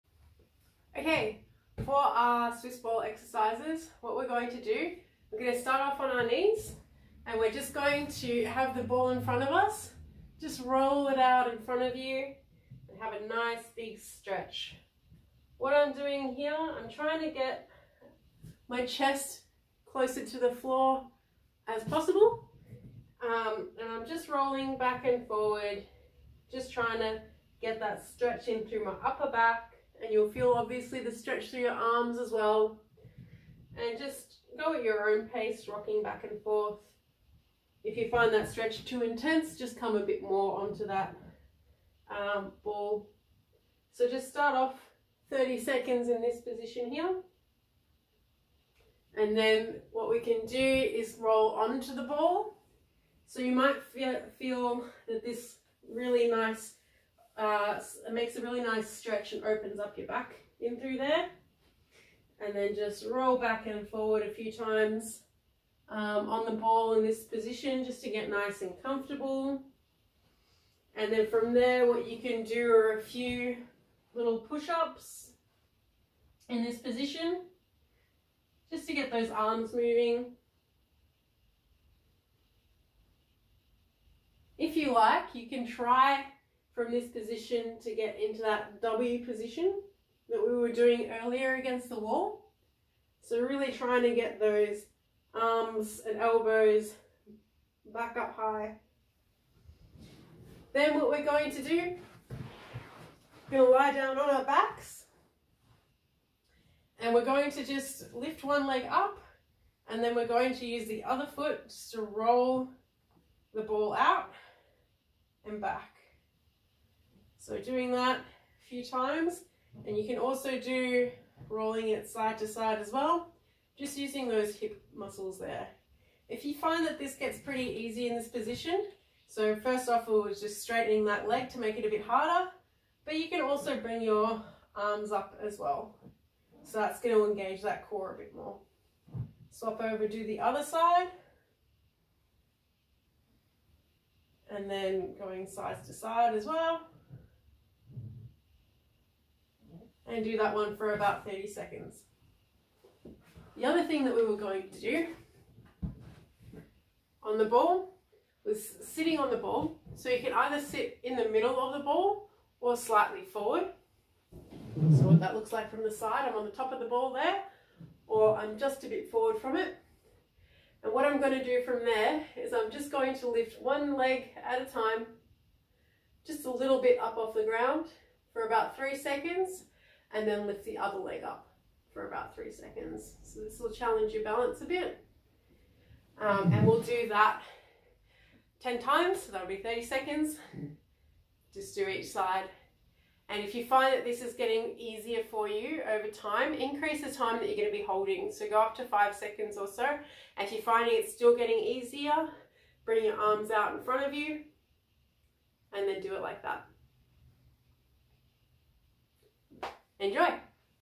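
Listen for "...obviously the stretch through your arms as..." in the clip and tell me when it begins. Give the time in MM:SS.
00:30.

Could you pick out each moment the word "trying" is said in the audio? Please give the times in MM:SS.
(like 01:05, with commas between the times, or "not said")
00:16, 00:26, 01:33.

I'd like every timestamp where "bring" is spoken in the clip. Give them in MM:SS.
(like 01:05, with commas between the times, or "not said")
02:13, 03:22.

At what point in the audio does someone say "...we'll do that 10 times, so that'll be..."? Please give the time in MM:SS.
03:06.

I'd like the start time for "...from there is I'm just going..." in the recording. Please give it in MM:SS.
02:51.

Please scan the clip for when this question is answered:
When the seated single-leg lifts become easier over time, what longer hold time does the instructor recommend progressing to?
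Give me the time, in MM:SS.
03:18.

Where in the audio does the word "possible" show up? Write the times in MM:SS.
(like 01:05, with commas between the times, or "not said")
00:21.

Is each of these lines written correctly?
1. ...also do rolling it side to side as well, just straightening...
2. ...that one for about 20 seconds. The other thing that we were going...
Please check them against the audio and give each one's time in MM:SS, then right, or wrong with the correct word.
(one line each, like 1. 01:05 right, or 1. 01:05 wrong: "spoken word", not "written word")
1. 02:00 wrong: "using", not "straightening"
2. 02:30 wrong: "30", not "20".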